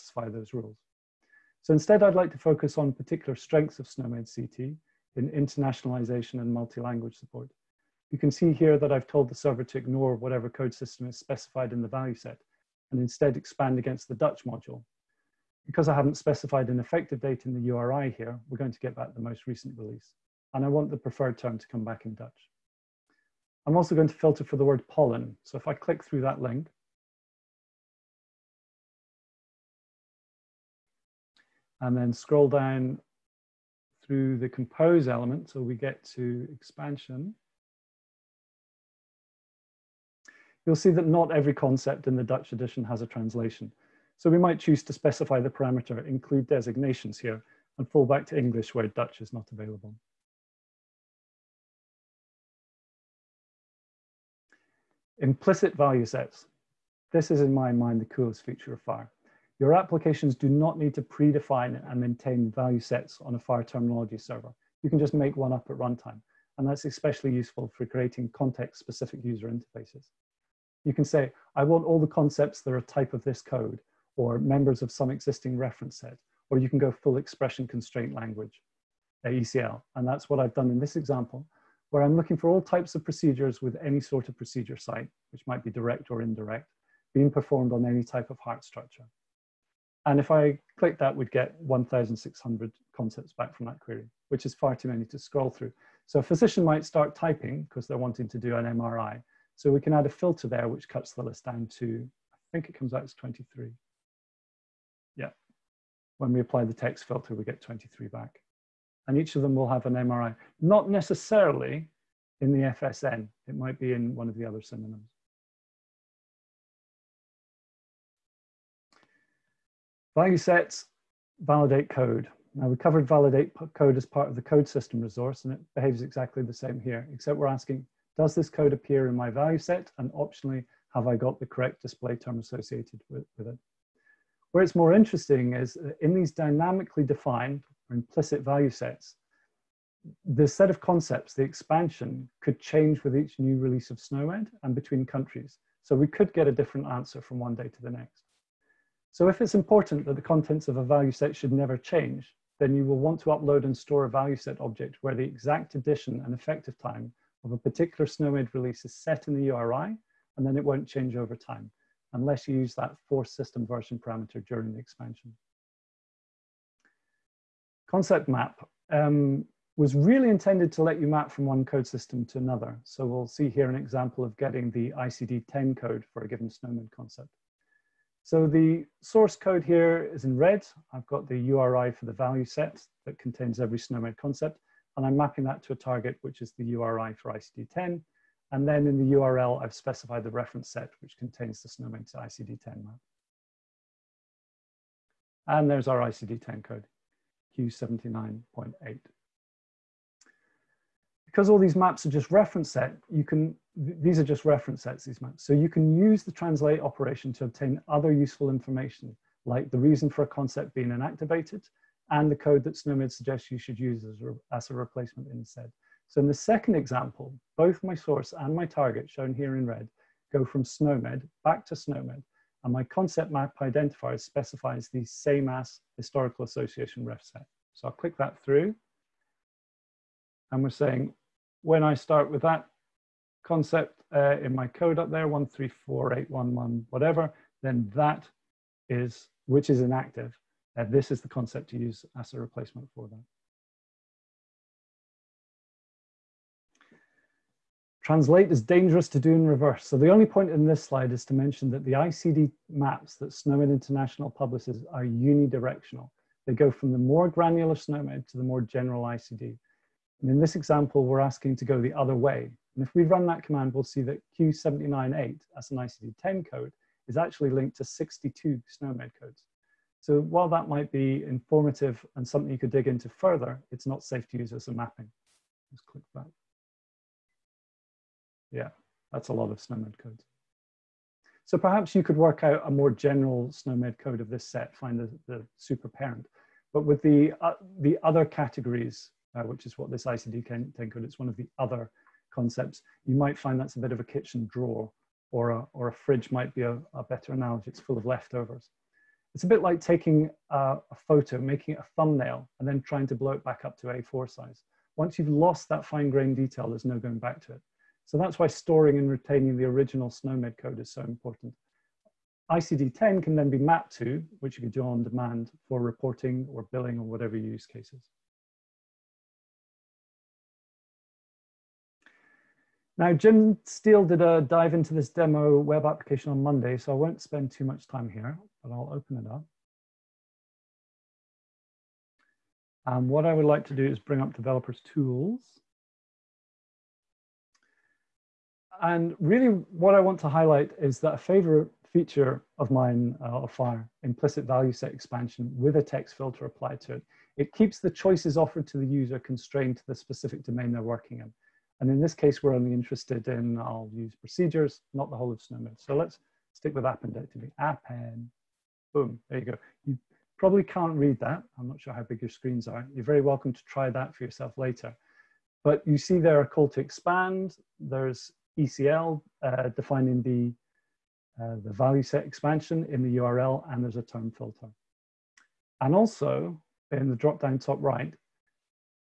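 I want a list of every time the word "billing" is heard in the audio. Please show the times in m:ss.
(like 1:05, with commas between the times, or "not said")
5:16.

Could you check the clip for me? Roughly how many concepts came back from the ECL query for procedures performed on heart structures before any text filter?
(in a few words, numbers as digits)
1,600.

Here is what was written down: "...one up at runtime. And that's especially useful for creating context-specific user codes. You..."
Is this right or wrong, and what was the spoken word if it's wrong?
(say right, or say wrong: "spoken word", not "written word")
wrong: "interfaces", not "codes".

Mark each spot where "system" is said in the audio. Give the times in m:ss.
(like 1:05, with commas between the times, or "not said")
0:10, 2:04, 2:43, 2:51.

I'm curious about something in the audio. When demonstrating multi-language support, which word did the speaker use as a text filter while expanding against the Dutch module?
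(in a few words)
pollen.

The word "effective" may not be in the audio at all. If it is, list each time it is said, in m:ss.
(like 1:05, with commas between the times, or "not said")
0:16, 2:36.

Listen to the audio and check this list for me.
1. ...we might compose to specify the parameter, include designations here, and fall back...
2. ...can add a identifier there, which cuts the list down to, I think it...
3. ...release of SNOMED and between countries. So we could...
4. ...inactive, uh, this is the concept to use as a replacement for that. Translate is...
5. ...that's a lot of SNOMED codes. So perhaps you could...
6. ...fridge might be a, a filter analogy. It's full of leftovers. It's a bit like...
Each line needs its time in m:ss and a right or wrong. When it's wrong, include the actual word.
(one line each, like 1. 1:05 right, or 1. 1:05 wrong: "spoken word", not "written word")
1. 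0:44 wrong: "choose", not "compose"
2. 1:39 wrong: "filter", not "identifier"
3. 2:23 right
4. 3:59 right
5. 4:39 right
6. 4:55 wrong: "better", not "filter".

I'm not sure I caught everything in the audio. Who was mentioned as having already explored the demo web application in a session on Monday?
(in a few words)
Jim Steel.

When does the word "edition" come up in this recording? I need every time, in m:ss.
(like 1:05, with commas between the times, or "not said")
0:42, 2:35.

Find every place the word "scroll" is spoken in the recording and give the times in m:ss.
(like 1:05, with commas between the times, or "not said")
0:32, 1:35.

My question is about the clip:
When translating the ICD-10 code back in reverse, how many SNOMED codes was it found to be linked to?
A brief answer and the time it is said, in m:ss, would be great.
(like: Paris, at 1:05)
62, at 4:27.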